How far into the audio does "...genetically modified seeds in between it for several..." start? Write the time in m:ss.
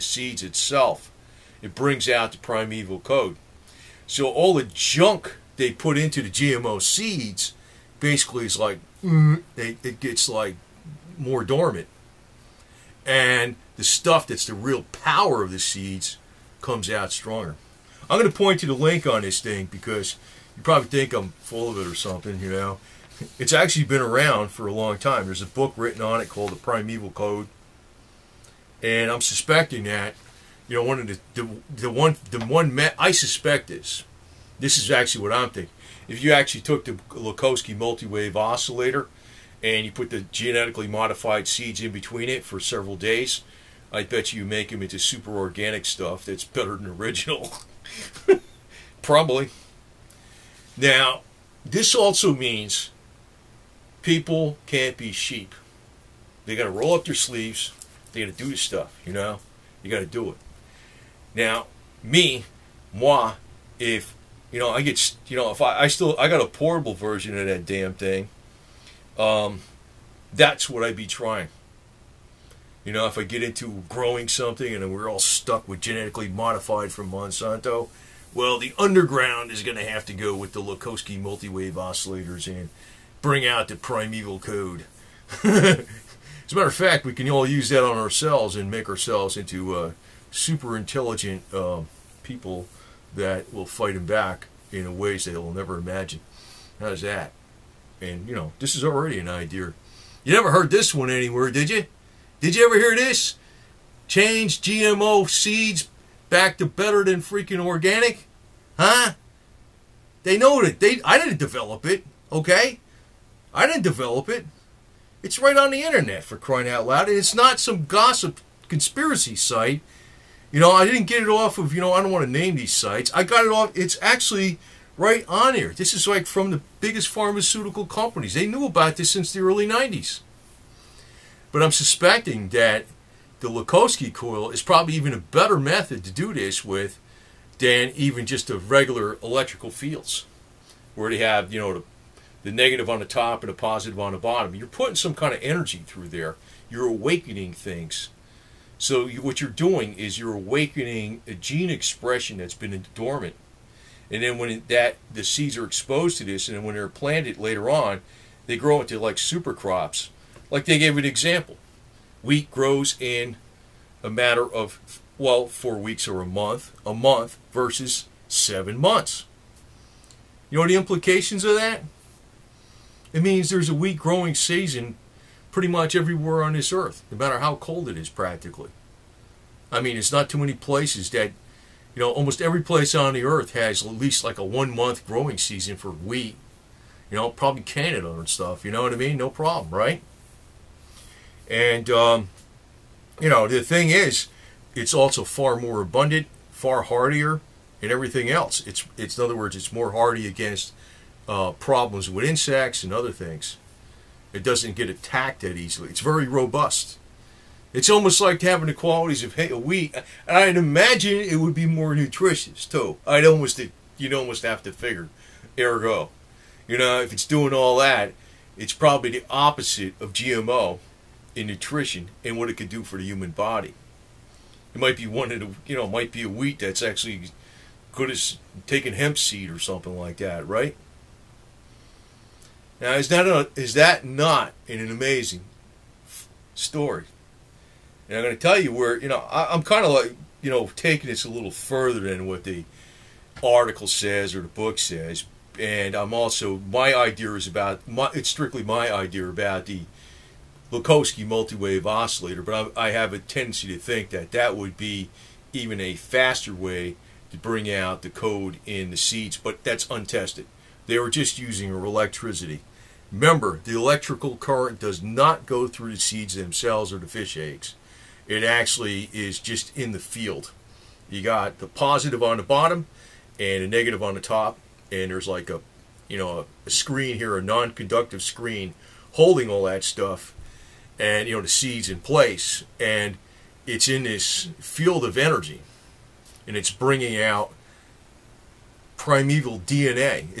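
0:40.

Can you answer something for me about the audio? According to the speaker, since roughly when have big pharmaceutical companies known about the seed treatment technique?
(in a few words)
early 90s.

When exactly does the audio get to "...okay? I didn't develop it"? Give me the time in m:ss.
1:52.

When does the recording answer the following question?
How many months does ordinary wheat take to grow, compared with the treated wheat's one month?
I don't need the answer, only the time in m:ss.
2:48.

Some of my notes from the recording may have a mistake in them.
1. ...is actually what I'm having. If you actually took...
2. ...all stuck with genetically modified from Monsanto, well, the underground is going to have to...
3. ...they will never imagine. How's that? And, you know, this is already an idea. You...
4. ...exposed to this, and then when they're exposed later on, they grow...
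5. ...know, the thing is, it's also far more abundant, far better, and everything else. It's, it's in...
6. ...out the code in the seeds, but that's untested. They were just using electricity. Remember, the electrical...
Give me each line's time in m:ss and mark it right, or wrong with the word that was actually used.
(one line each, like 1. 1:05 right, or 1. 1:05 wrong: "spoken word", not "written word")
1. 0:34 wrong: "thinking", not "having"
2. 1:15 right
3. 1:35 right
4. 2:35 wrong: "planted", not "exposed"
5. 3:13 wrong: "hardier", not "better"
6. 4:17 right.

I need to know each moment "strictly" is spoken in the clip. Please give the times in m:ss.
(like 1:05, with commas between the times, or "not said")
4:08.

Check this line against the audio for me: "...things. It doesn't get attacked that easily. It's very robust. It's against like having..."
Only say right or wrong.
wrong.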